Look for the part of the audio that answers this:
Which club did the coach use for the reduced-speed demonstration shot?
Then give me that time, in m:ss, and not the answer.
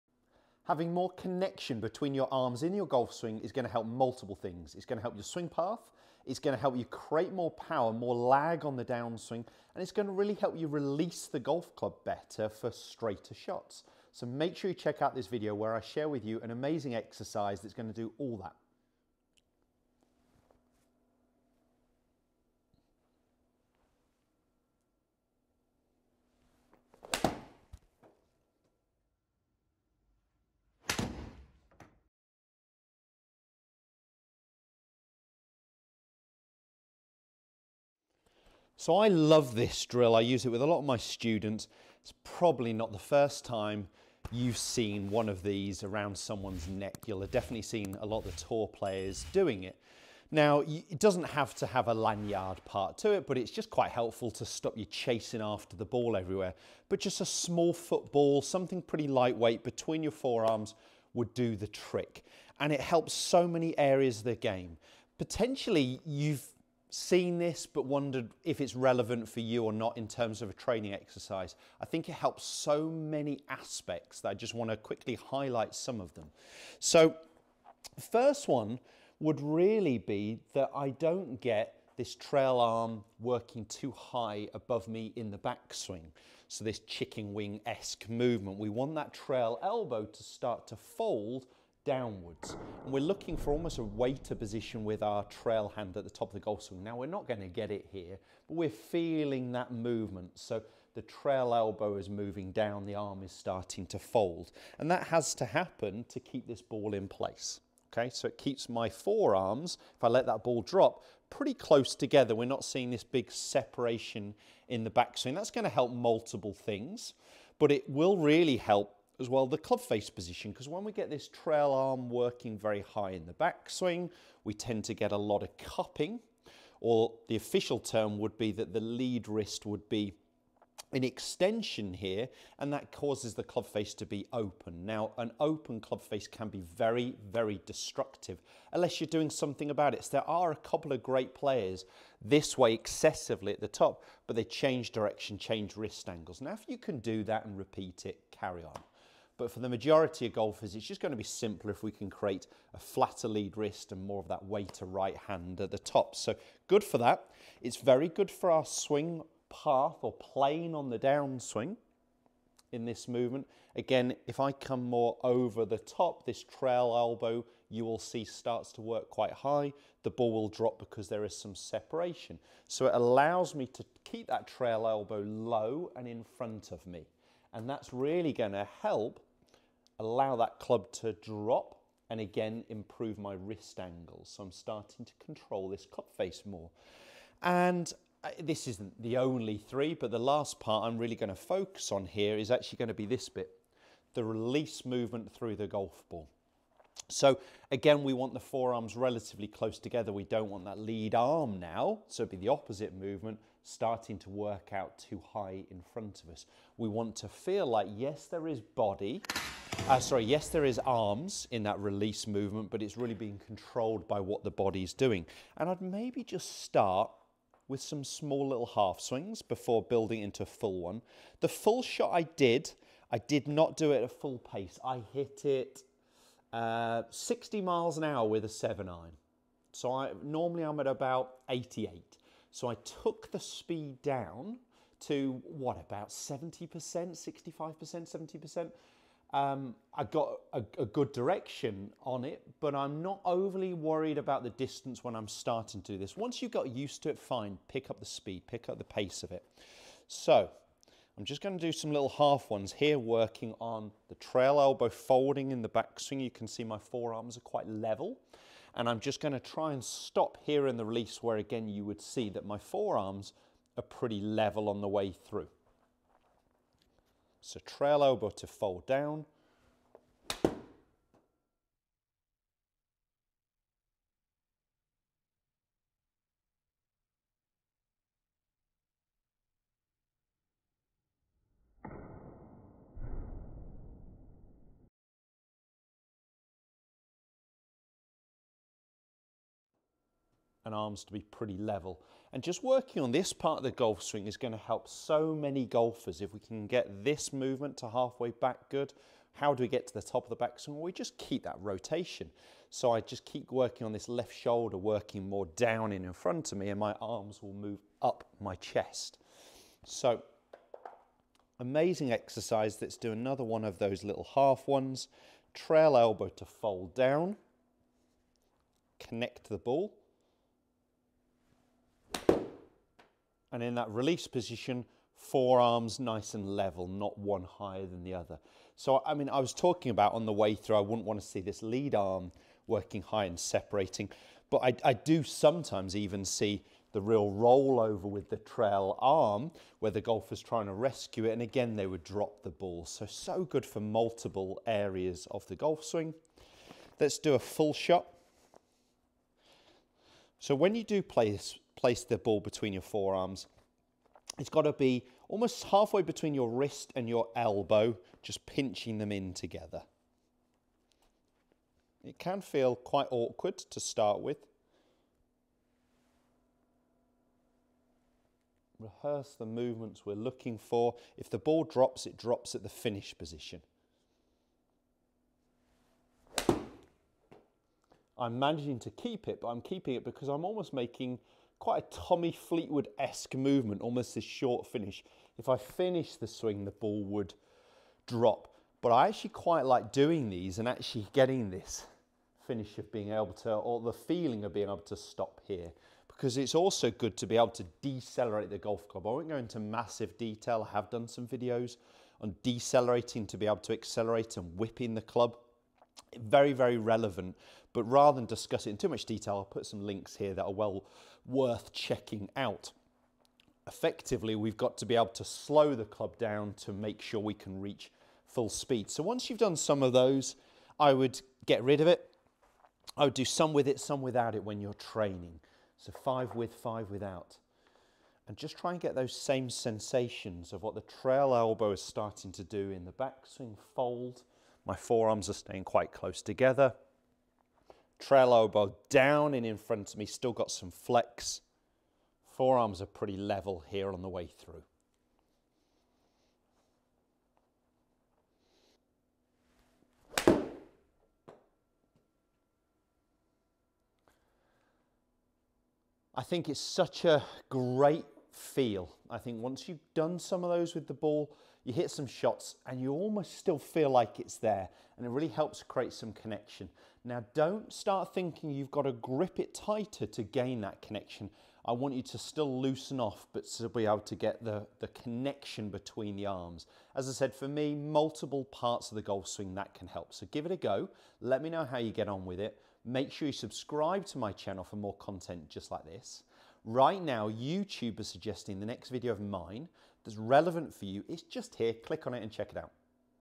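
3:48.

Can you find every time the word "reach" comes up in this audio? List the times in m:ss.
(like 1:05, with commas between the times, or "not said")
6:57.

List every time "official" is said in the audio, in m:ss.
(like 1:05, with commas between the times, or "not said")
2:07.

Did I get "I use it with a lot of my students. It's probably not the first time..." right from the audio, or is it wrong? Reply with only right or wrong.
right.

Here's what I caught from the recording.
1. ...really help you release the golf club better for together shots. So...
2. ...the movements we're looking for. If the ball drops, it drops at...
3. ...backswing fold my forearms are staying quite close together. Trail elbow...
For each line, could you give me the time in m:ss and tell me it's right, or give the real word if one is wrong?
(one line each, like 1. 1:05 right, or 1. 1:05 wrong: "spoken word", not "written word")
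1. 0:10 wrong: "straighter", not "together"
2. 6:09 right
3. 7:12 right.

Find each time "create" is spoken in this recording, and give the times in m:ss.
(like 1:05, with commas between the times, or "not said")
0:06, 2:32, 7:45.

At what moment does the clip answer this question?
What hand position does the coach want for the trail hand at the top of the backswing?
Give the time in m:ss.
1:33.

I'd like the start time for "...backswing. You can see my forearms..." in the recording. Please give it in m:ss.
4:15.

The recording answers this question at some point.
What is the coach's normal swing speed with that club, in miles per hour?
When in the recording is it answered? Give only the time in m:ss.
3:51.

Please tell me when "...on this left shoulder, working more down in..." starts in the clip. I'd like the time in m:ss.
5:03.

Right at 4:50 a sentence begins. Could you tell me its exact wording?
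and arms to be pretty level.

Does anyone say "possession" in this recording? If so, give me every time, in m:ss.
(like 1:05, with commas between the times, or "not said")
not said.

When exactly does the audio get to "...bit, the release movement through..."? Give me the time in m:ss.
3:13.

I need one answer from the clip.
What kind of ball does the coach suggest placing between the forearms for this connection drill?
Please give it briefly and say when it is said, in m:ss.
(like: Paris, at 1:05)
small football, at 0:57.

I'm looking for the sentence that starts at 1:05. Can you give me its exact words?
Potentially, you've seen this but wondered if it's relevant for you or not in terms of a training exercise.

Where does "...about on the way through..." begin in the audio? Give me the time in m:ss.
5:29.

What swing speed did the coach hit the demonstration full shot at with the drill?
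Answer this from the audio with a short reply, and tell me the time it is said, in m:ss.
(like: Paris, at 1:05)
60 mph, at 3:47.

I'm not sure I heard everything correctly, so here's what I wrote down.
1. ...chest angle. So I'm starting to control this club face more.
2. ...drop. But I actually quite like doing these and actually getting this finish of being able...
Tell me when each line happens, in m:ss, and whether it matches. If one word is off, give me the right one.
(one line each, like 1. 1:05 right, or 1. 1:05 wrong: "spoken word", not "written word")
1. 3:03 wrong: "wrist", not "chest"
2. 6:28 right.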